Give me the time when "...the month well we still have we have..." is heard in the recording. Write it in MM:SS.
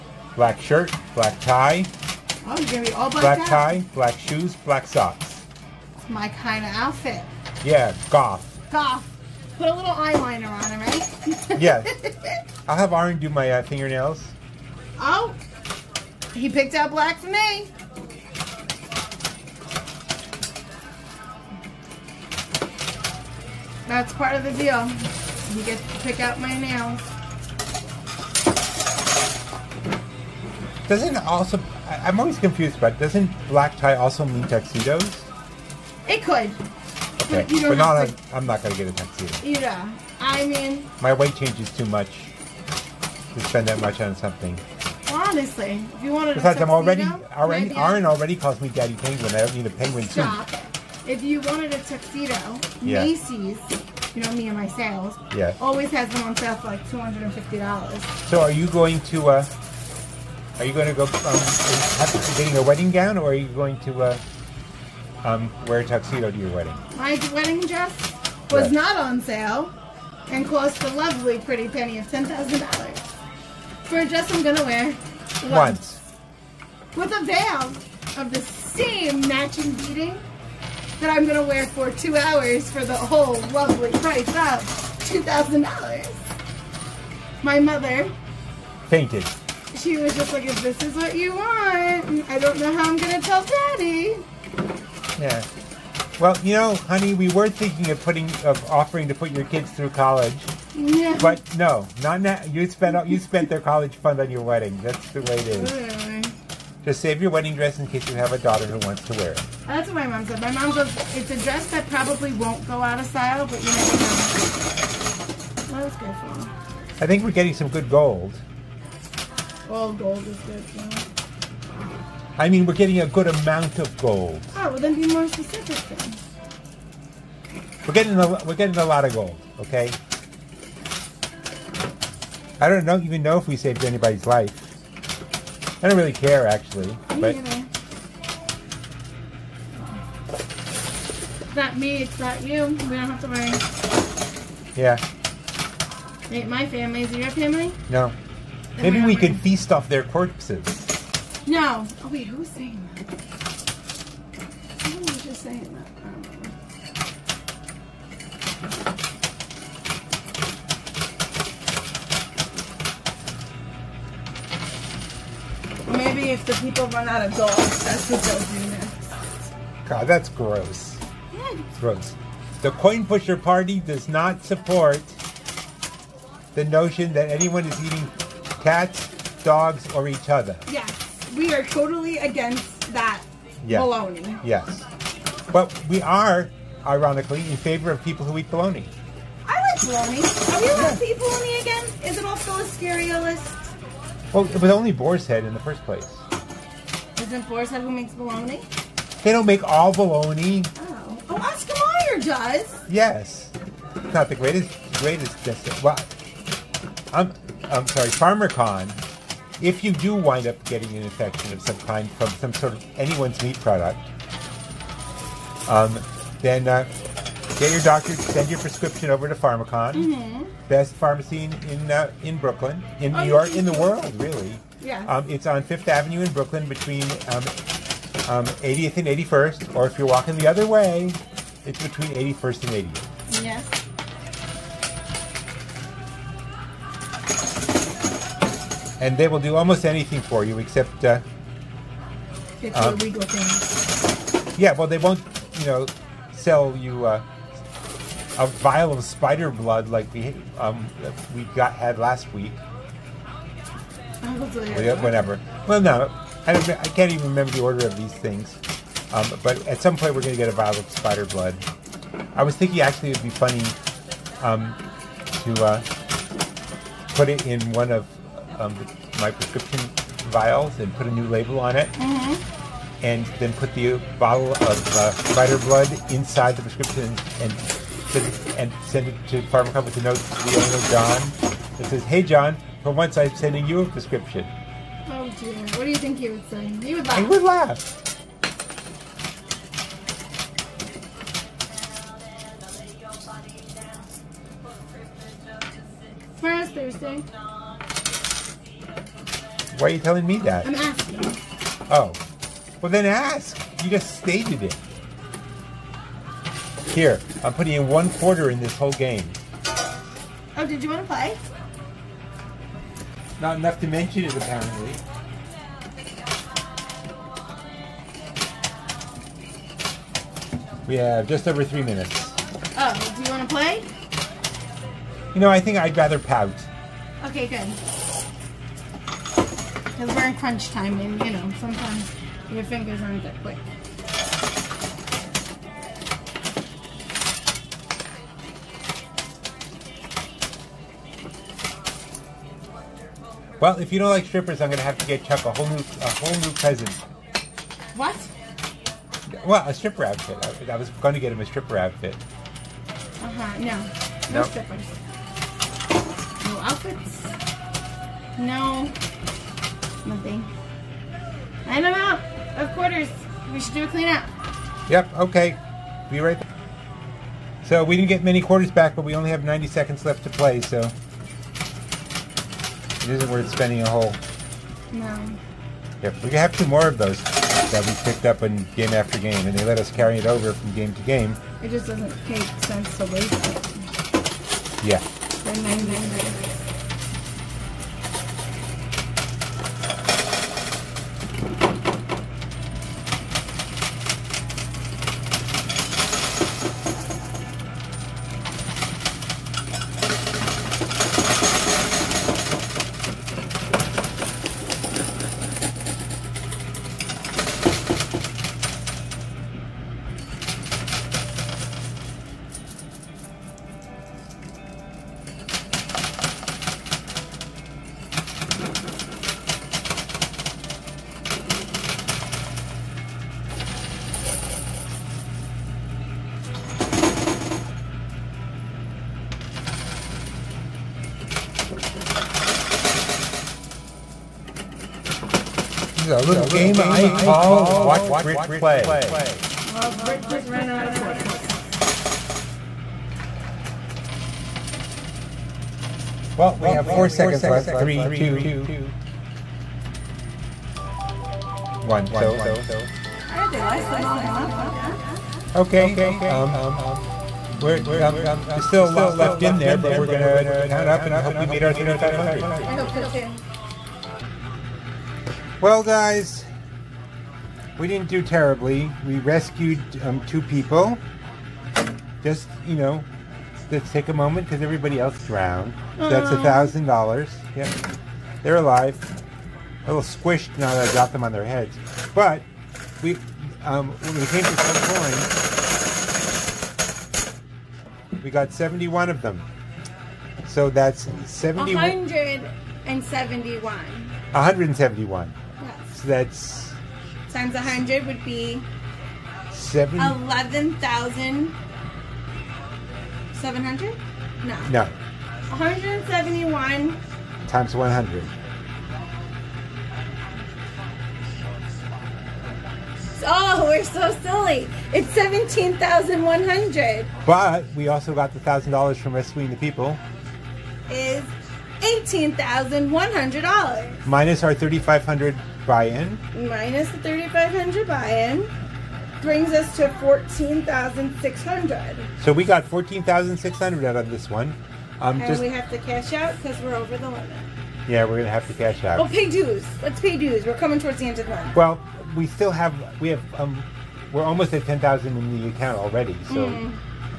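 09:01.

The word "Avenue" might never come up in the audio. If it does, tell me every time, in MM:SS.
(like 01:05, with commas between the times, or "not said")
03:45.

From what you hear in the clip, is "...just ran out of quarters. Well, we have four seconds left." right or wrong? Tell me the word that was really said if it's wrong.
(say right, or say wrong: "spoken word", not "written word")
right.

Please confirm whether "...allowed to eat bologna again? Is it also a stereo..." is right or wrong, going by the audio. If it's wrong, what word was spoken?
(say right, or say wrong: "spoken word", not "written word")
right.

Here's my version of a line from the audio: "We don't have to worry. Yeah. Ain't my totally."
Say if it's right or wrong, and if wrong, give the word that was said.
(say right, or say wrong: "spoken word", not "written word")
wrong: "family", not "totally".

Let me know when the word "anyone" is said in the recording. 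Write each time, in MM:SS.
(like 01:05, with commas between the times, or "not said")
02:57, 03:32.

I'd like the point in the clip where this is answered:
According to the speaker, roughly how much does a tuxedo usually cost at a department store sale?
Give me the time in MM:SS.
00:56.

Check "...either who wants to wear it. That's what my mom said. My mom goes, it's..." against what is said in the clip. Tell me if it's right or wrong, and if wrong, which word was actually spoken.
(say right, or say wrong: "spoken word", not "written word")
wrong: "daughter", not "either".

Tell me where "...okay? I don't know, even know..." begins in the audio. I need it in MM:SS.
02:09.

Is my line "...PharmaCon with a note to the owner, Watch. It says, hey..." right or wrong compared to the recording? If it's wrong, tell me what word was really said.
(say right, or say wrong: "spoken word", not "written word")
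wrong: "John", not "Watch".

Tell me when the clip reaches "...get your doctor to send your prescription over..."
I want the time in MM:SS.
03:37.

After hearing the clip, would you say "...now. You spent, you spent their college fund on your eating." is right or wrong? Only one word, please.
wrong.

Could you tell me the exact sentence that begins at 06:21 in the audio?
It just doesn't make sense to waste it.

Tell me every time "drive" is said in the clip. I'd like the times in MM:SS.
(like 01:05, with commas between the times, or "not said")
not said.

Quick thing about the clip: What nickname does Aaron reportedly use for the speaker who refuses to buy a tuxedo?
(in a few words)
Daddy Penguin.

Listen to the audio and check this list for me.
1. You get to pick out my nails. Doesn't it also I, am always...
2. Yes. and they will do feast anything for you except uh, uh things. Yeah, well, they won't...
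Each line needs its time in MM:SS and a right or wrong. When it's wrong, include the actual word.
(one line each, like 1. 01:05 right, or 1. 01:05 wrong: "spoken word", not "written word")
1. 00:25 right
2. 03:53 wrong: "almost", not "feast".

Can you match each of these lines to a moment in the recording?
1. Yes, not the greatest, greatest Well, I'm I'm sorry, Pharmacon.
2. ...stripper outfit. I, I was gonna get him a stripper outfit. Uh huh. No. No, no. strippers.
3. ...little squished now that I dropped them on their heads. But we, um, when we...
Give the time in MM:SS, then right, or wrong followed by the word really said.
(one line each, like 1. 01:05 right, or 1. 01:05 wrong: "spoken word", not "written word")
1. 03:22 right
2. 05:49 right
3. 07:59 right.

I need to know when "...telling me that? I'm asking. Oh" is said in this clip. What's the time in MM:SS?
04:59.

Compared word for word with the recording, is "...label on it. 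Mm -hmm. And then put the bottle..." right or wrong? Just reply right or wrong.
right.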